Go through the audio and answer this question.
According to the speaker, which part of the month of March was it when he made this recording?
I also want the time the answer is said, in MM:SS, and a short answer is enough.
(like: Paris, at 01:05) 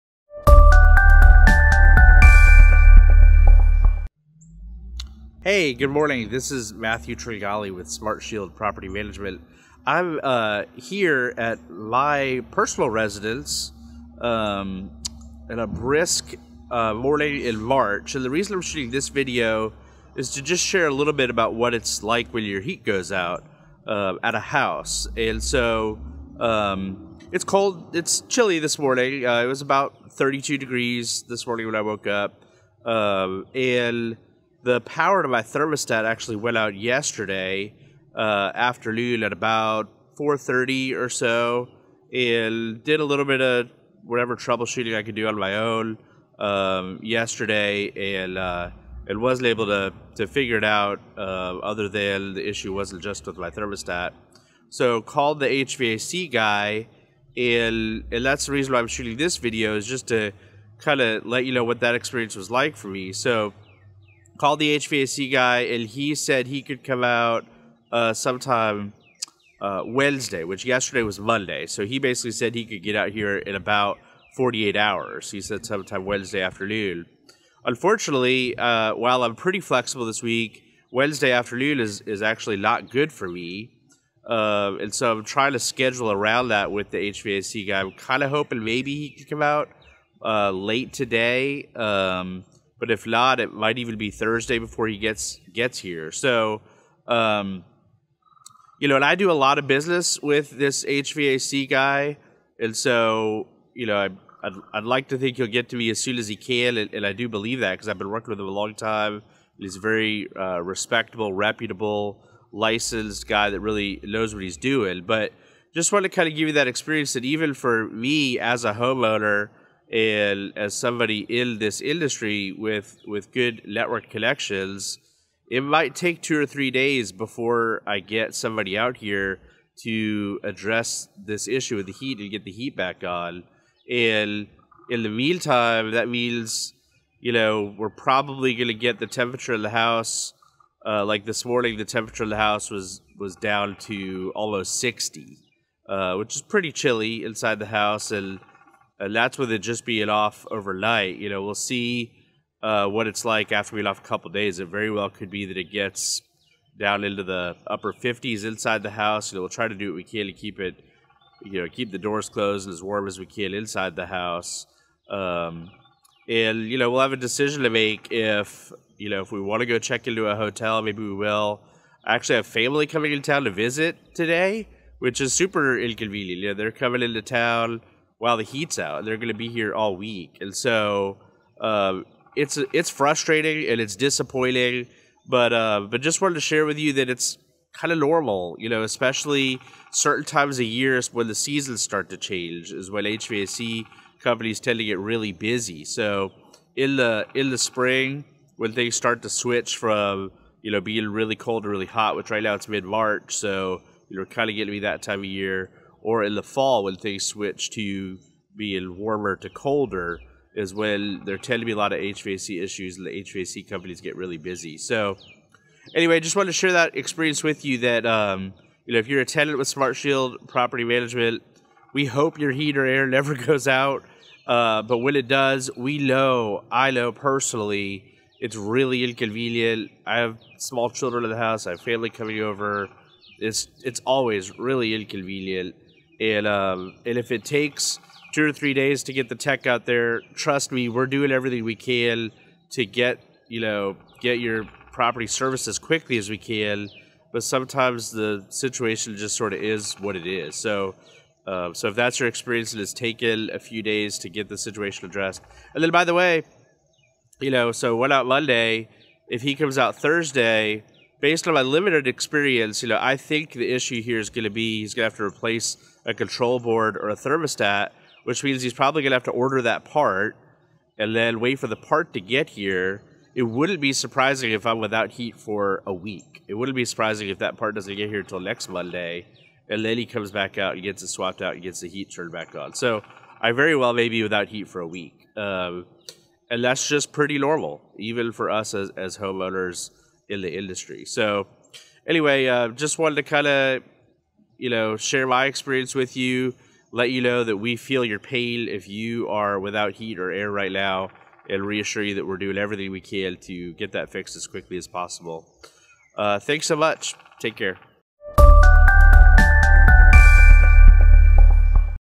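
mid March, at 03:22.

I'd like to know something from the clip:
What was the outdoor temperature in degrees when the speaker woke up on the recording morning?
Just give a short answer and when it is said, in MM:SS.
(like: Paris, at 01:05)
32, at 00:30.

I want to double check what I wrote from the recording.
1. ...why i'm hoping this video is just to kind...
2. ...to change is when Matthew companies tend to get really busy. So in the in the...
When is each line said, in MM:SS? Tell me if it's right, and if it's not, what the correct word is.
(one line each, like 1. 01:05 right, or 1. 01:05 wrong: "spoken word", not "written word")
1. 00:58 wrong: "shooting", not "hoping"
2. 03:12 wrong: "HVAC", not "Matthew".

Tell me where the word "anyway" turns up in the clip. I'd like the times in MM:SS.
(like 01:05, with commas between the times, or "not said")
03:35, 04:52.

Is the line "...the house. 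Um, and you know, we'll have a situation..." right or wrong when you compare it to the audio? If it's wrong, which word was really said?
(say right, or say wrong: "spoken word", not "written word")
wrong: "decision", not "situation".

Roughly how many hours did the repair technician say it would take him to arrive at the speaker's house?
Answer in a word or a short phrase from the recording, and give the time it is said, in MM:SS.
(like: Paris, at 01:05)
48, at 01:14.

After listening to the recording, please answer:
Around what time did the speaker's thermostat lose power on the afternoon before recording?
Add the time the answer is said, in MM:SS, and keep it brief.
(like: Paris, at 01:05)
4:30, at 00:40.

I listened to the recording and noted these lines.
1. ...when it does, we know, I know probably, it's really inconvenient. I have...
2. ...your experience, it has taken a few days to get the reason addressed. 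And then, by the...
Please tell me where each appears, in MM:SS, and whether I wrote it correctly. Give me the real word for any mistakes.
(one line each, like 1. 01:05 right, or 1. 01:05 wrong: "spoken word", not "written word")
1. 03:44 wrong: "personally", not "probably"
2. 04:12 wrong: "situation", not "reason".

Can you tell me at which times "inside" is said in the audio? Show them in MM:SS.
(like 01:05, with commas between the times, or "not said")
02:27, 02:38, 02:43.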